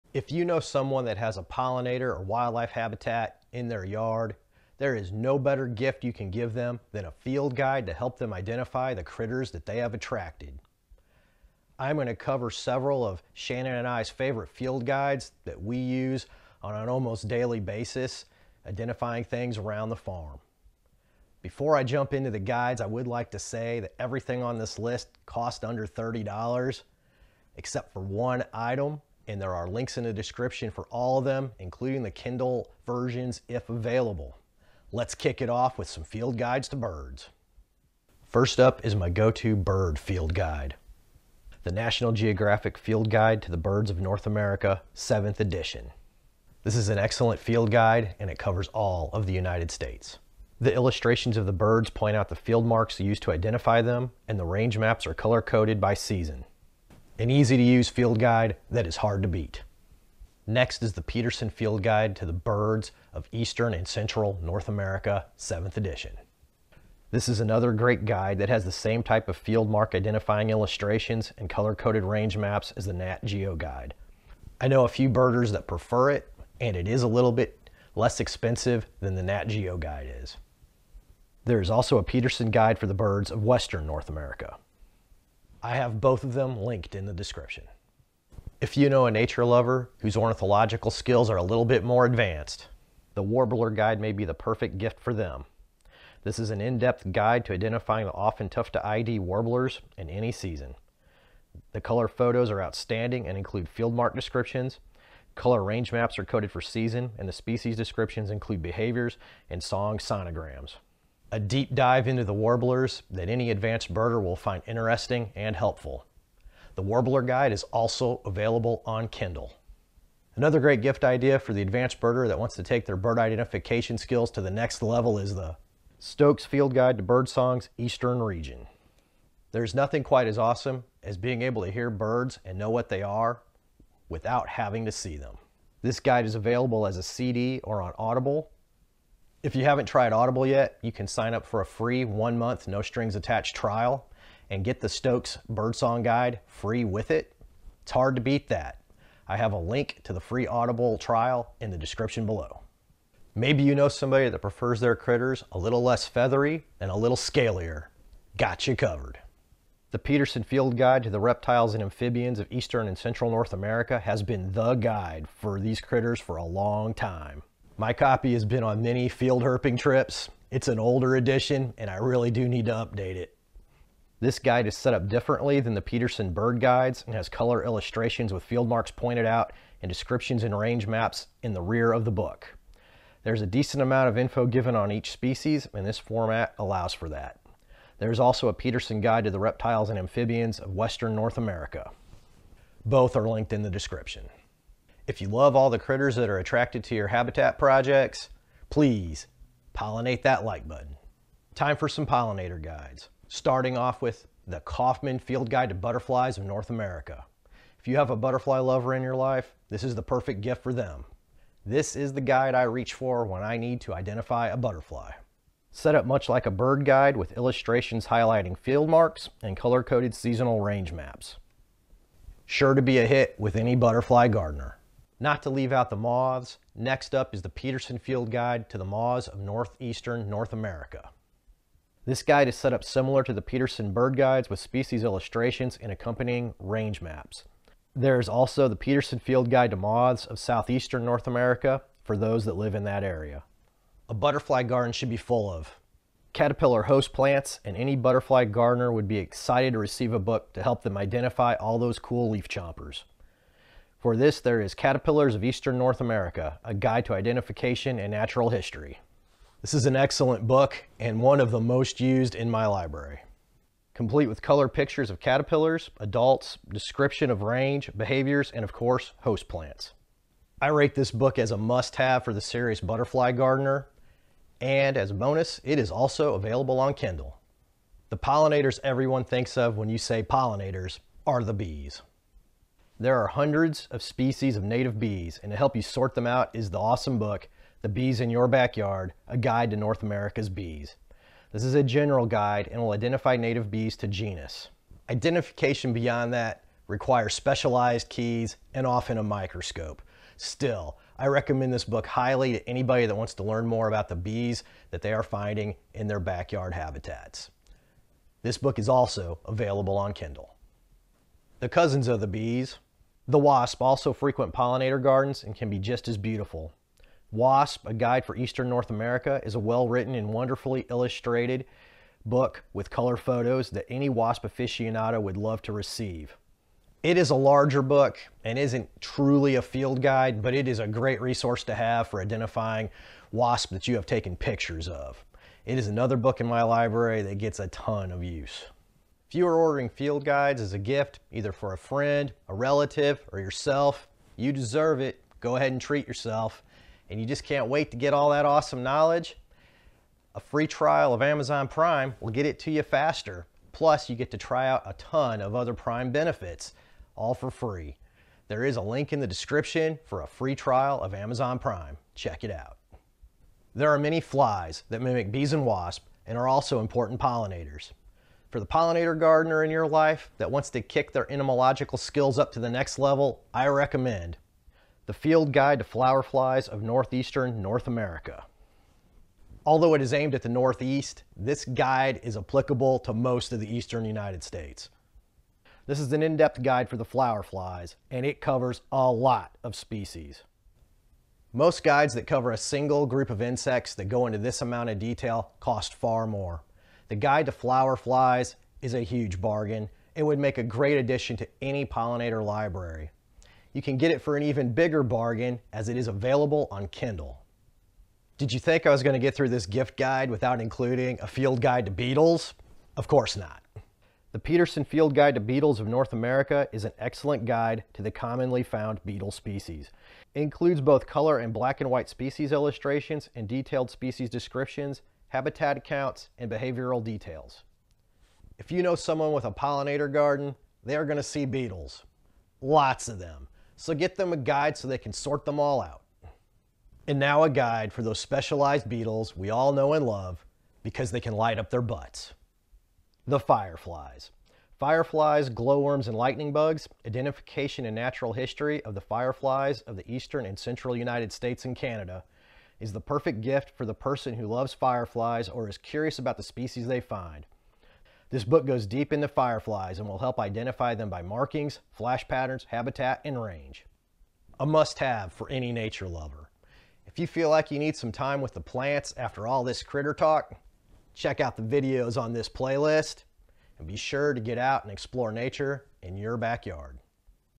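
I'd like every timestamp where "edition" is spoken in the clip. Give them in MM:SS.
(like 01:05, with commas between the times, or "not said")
00:45, 01:05, 02:51.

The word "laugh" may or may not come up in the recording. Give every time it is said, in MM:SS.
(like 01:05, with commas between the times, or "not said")
not said.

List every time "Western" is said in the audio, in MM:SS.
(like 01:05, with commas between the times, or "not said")
01:23, 03:10.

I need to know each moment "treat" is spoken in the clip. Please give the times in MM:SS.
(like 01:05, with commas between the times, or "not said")
05:45.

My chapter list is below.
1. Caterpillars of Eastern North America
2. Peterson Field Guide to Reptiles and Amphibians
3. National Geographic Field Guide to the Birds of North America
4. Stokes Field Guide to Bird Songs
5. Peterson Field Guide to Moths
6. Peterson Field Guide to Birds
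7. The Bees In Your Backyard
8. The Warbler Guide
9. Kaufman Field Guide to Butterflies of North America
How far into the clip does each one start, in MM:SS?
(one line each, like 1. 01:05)
1. 04:04
2. 02:33
3. 00:38
4. 02:00
5. 03:45
6. 01:00
7. 04:38
8. 01:28
9. 03:21.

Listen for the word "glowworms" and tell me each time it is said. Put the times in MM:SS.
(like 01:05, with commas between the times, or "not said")
07:25.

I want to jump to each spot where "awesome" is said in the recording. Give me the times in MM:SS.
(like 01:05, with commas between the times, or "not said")
02:10, 04:46, 05:48.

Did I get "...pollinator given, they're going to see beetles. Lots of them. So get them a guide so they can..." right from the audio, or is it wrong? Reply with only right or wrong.
wrong.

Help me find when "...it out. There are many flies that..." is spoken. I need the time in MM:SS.
06:02.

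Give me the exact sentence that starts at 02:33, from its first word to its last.
Maybe you know somebody that prefers their critters a little less feathery and a little scalier.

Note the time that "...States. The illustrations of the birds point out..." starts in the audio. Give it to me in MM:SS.
00:49.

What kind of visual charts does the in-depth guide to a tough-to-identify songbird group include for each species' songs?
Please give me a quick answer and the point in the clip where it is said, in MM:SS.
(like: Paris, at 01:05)
Song sonograms, at 01:49.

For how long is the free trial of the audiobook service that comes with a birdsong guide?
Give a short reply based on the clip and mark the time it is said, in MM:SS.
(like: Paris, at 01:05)
One month, at 02:22.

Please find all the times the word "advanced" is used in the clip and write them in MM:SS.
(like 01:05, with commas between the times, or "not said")
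01:32, 01:53, 02:01.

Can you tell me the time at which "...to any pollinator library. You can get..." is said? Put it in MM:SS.
06:41.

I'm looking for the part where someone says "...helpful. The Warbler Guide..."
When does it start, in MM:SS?
01:55.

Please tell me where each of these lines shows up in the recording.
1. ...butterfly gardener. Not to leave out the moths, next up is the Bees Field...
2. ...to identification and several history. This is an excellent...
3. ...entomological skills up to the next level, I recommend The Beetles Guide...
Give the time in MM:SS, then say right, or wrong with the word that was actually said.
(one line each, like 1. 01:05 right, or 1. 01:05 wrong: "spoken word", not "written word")
1. 03:43 wrong: "Peterson", not "Bees"
2. 04:17 wrong: "natural", not "several"
3. 06:11 wrong: "Field", not "Beetles".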